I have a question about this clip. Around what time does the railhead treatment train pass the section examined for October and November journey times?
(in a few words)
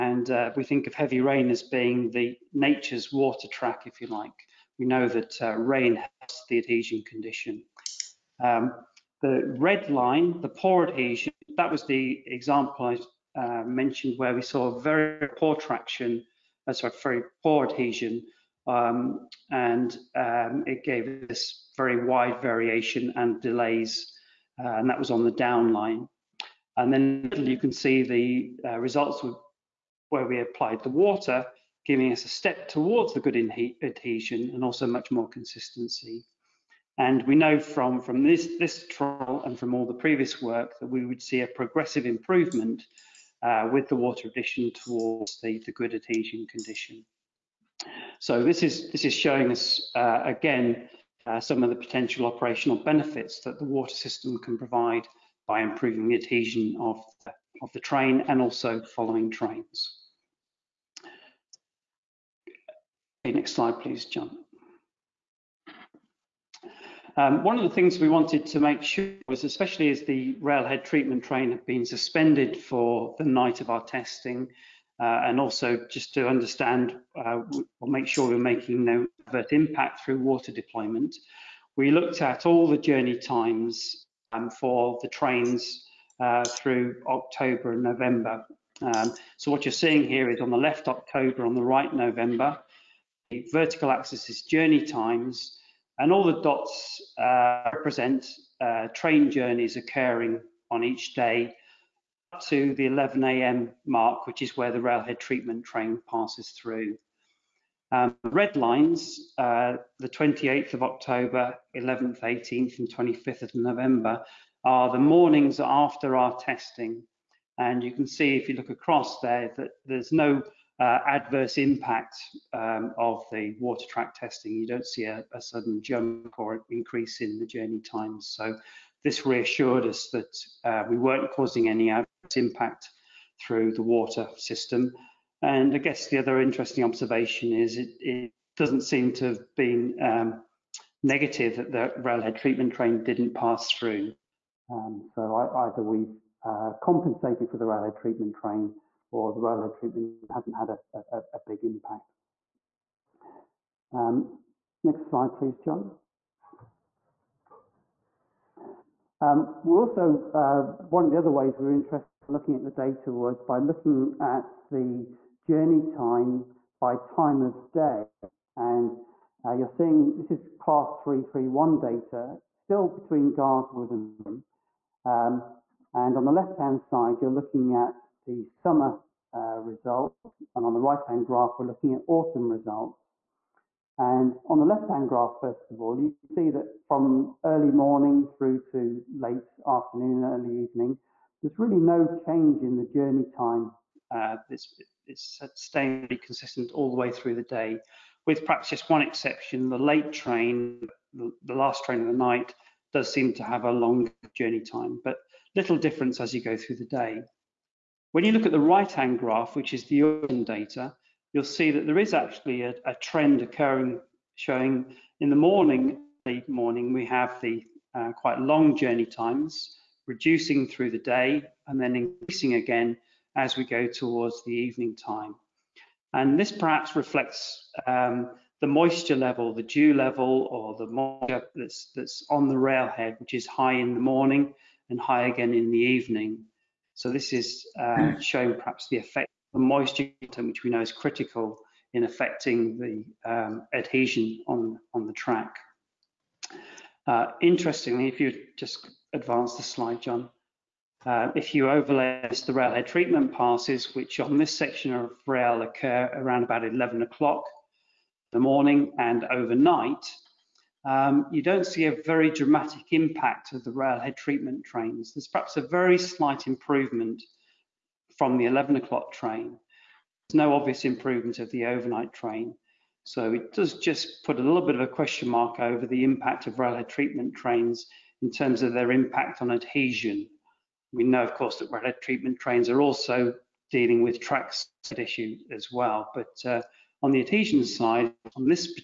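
11 a.m.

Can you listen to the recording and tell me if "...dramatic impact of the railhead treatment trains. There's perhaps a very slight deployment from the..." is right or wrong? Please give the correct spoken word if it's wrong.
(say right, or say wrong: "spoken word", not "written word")
wrong: "improvement", not "deployment".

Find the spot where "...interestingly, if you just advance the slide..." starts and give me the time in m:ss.
4:07.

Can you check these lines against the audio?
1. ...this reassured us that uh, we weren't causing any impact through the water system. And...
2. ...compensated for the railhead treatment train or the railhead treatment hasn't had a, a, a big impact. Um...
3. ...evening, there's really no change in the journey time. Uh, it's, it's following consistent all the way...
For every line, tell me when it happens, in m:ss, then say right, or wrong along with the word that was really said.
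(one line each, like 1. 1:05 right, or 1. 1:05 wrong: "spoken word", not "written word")
1. 2:09 right
2. 2:26 right
3. 3:10 wrong: "staying", not "following".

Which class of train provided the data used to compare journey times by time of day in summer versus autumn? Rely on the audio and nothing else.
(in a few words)
Class 331.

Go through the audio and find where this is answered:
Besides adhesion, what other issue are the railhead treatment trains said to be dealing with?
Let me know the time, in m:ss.
4:44.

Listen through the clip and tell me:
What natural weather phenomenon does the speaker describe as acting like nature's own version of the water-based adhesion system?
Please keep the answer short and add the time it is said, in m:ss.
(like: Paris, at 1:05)
Heavy rain, at 0:00.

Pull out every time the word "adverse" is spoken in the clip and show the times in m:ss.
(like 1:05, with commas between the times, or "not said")
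1:19, 2:01.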